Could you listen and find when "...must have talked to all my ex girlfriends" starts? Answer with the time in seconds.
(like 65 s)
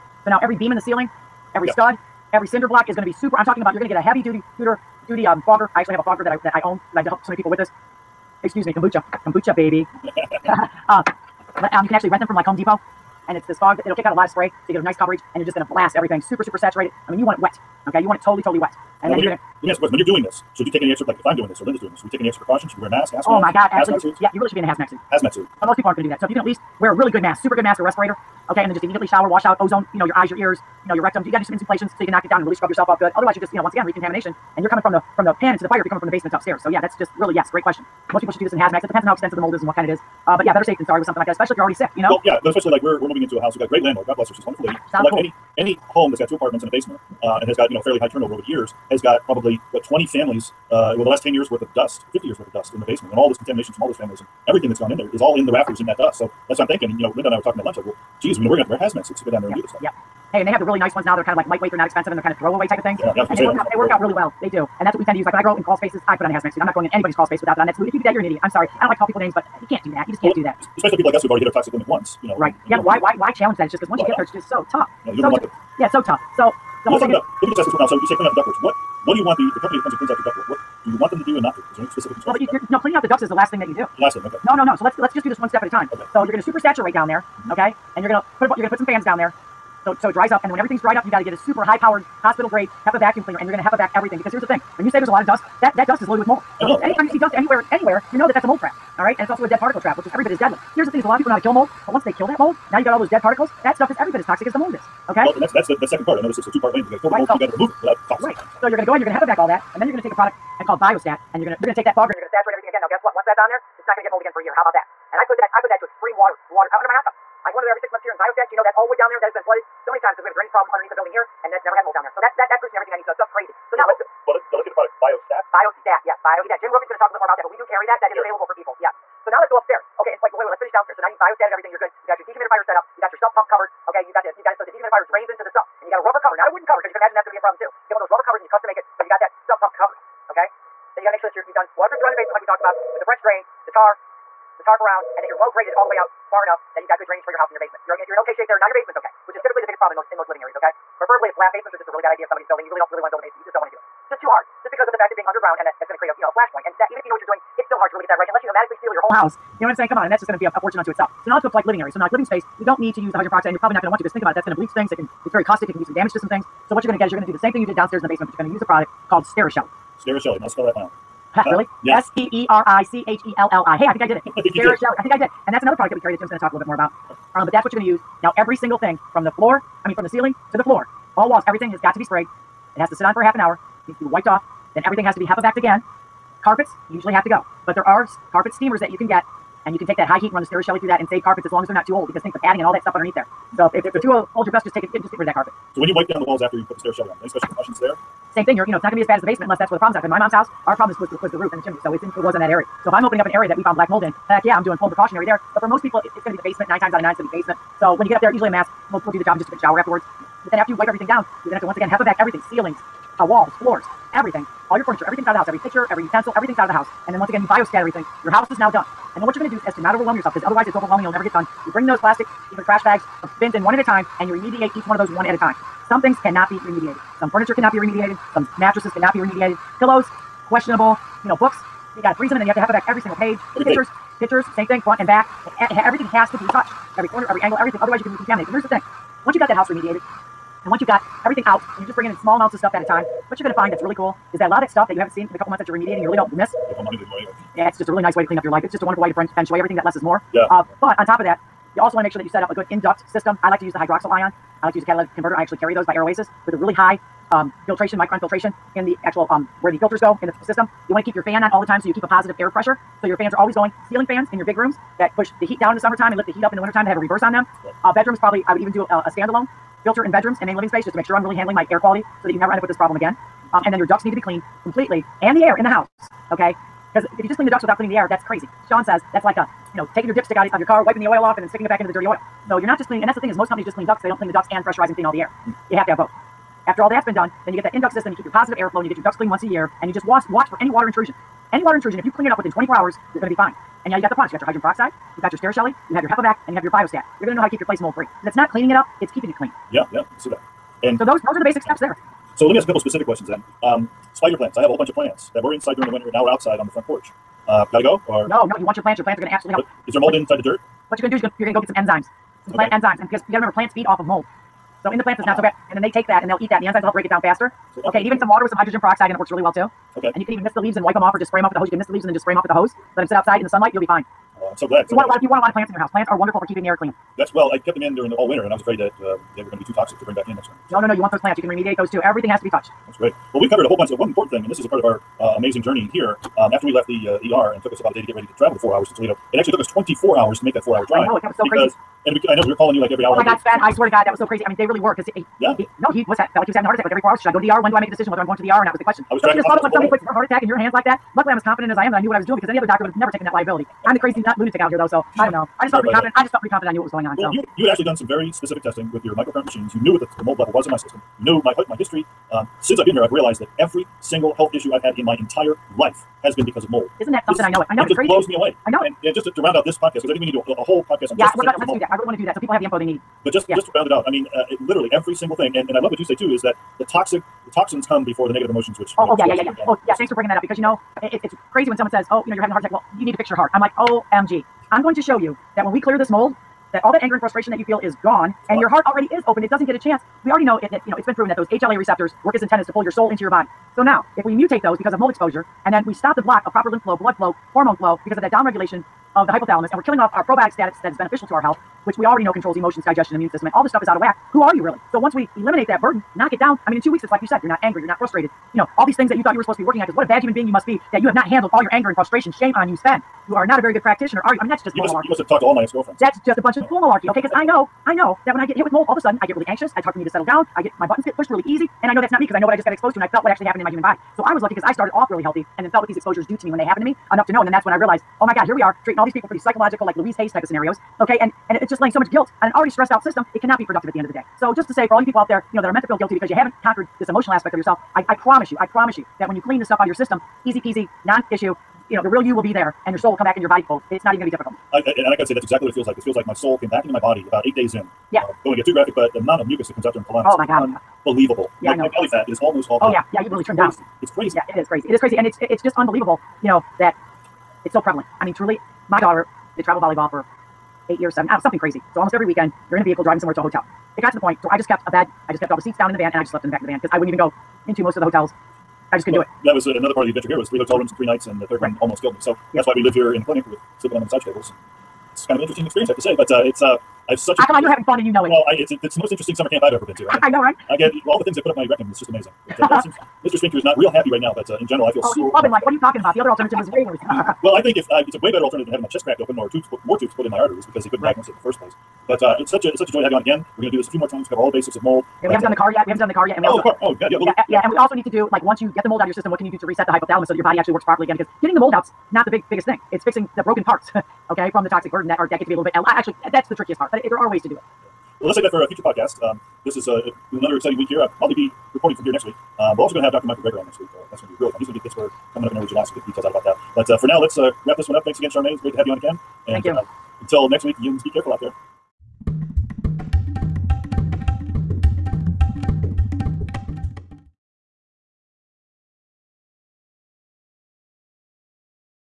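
415 s.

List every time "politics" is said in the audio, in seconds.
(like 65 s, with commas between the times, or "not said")
not said.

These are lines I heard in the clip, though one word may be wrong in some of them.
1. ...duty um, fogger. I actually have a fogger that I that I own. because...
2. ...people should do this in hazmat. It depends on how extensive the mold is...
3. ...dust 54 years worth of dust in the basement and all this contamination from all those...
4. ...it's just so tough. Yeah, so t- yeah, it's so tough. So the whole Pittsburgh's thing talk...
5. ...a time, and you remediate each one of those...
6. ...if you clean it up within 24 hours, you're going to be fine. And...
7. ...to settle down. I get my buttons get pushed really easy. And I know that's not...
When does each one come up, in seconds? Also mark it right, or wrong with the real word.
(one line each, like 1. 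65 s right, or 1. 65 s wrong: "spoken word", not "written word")
1. 5 s right
2. 38 s right
3. 51 s wrong: "50", not "54"
4. 74 s wrong: "Let", not "Pittsburgh"
5. 223 s right
6. 291 s right
7. 420 s right.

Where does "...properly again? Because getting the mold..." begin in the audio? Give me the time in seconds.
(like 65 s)
500 s.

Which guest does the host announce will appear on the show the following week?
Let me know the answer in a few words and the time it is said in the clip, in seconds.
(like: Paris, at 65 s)
Dr. Michael Greger, at 513 s.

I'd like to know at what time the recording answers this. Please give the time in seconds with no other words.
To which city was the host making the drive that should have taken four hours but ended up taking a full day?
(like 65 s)
338 s.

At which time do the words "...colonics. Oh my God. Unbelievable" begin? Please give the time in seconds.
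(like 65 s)
450 s.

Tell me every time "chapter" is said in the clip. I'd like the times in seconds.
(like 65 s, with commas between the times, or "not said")
not said.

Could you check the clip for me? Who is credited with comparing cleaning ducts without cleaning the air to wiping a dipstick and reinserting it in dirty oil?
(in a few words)
Sean.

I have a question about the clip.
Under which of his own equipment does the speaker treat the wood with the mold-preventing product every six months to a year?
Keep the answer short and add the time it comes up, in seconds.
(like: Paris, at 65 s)
Hot tubs, at 116 s.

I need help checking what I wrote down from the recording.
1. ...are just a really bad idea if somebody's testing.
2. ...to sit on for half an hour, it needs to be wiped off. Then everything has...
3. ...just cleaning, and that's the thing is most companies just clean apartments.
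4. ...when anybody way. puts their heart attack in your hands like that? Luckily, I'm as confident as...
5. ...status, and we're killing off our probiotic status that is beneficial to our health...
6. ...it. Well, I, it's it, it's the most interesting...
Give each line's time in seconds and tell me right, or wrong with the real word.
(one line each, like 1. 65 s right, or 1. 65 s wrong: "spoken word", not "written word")
1. 151 s wrong: "building", not "testing"
2. 182 s right
3. 282 s wrong: "ducts", not "apartments"
4. 349 s wrong: "somebody", not "anybody"
5. 399 s wrong: "hypothalamus", not "status"
6. 478 s right.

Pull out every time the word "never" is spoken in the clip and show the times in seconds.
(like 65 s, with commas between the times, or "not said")
121 s, 221 s, 272 s, 352 s.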